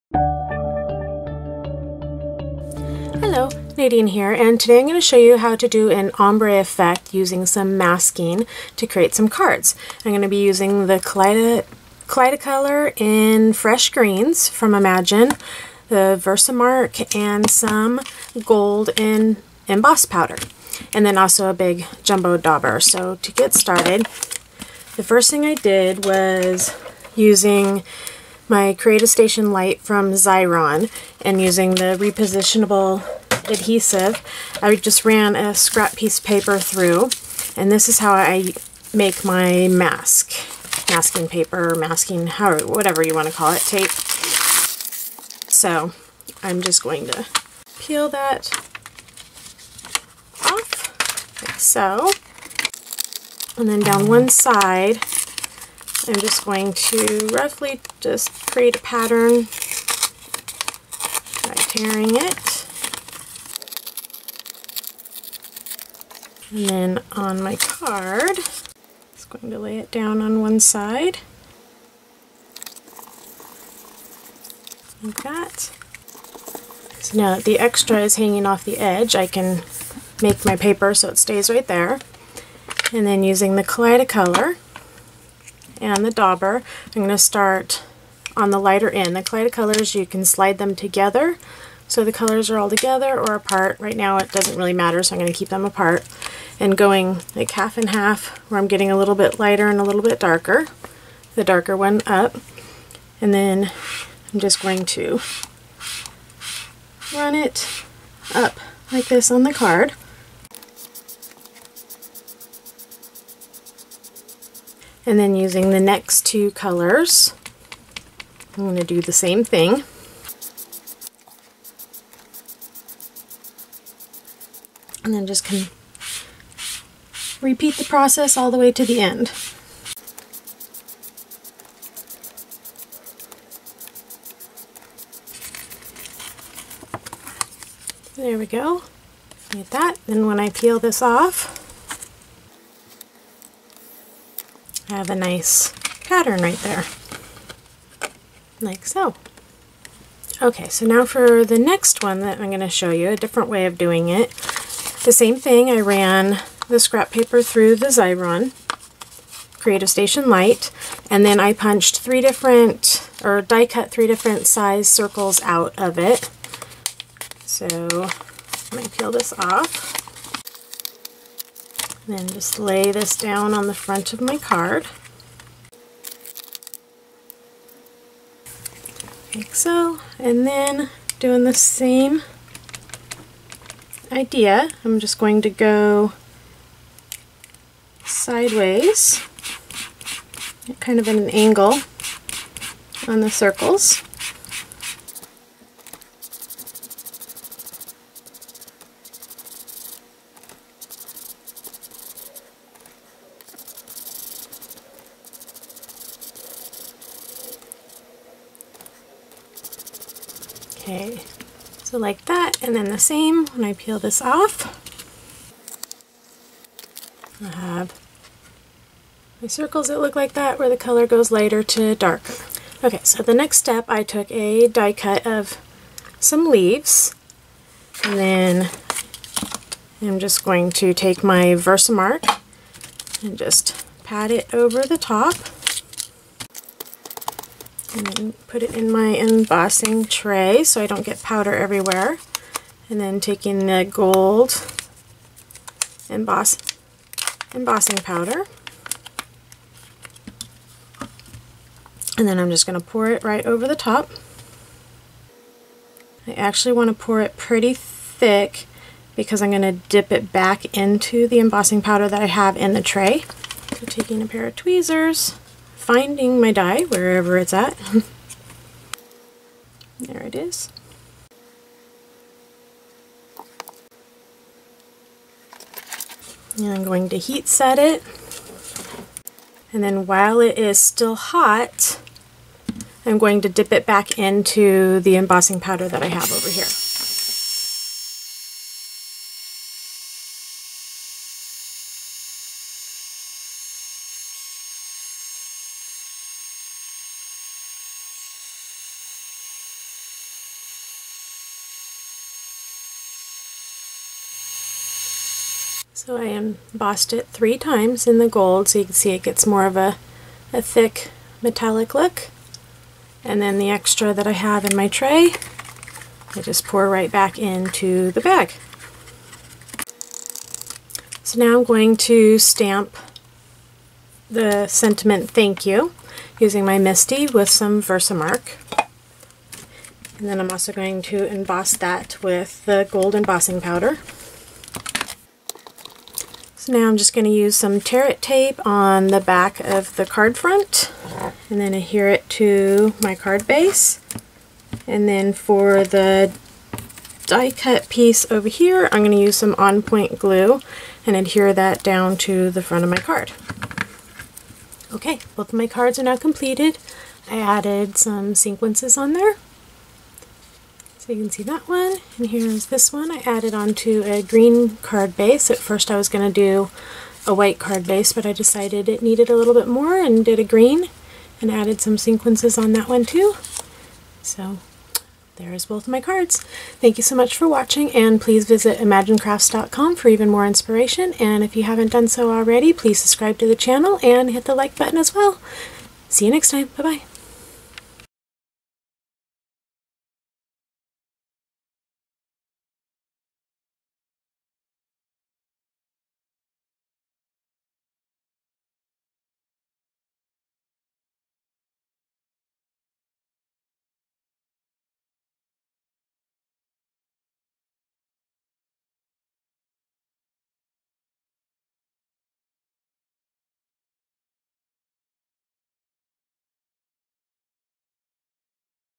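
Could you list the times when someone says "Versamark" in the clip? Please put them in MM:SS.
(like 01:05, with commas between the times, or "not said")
00:16, 03:51, 05:27.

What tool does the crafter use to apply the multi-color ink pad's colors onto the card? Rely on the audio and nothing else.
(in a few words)
jumbo dauber.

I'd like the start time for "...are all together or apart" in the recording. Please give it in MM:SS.
01:32.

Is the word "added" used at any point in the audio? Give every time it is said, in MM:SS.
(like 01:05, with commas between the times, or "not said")
05:57, 06:03, 06:11.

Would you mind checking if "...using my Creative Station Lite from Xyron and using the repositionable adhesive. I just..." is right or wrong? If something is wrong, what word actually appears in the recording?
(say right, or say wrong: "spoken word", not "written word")
right.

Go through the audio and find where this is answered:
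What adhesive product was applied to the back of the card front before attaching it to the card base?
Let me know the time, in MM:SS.
05:37.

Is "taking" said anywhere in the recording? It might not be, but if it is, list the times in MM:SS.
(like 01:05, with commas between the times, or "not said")
04:03, 04:23.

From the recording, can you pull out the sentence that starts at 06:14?
So there is both of my cards.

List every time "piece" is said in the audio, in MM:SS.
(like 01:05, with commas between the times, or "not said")
00:35, 05:47.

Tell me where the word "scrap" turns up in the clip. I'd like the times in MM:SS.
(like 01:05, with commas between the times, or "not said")
00:35, 02:36.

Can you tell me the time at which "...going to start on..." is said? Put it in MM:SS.
01:26.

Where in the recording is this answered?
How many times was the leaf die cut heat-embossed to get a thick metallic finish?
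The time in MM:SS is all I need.
05:07.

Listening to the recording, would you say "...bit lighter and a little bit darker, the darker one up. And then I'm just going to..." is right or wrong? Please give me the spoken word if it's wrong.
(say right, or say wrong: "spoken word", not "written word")
right.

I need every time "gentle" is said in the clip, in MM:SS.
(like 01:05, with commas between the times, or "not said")
not said.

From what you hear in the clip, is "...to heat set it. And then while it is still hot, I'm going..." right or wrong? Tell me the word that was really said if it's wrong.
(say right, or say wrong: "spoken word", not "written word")
right.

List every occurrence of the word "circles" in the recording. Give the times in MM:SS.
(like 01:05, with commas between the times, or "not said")
02:44, 03:13, 03:39.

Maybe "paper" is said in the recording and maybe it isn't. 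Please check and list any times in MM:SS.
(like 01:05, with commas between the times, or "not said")
00:36, 00:41, 01:20, 02:37.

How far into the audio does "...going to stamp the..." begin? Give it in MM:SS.
05:21.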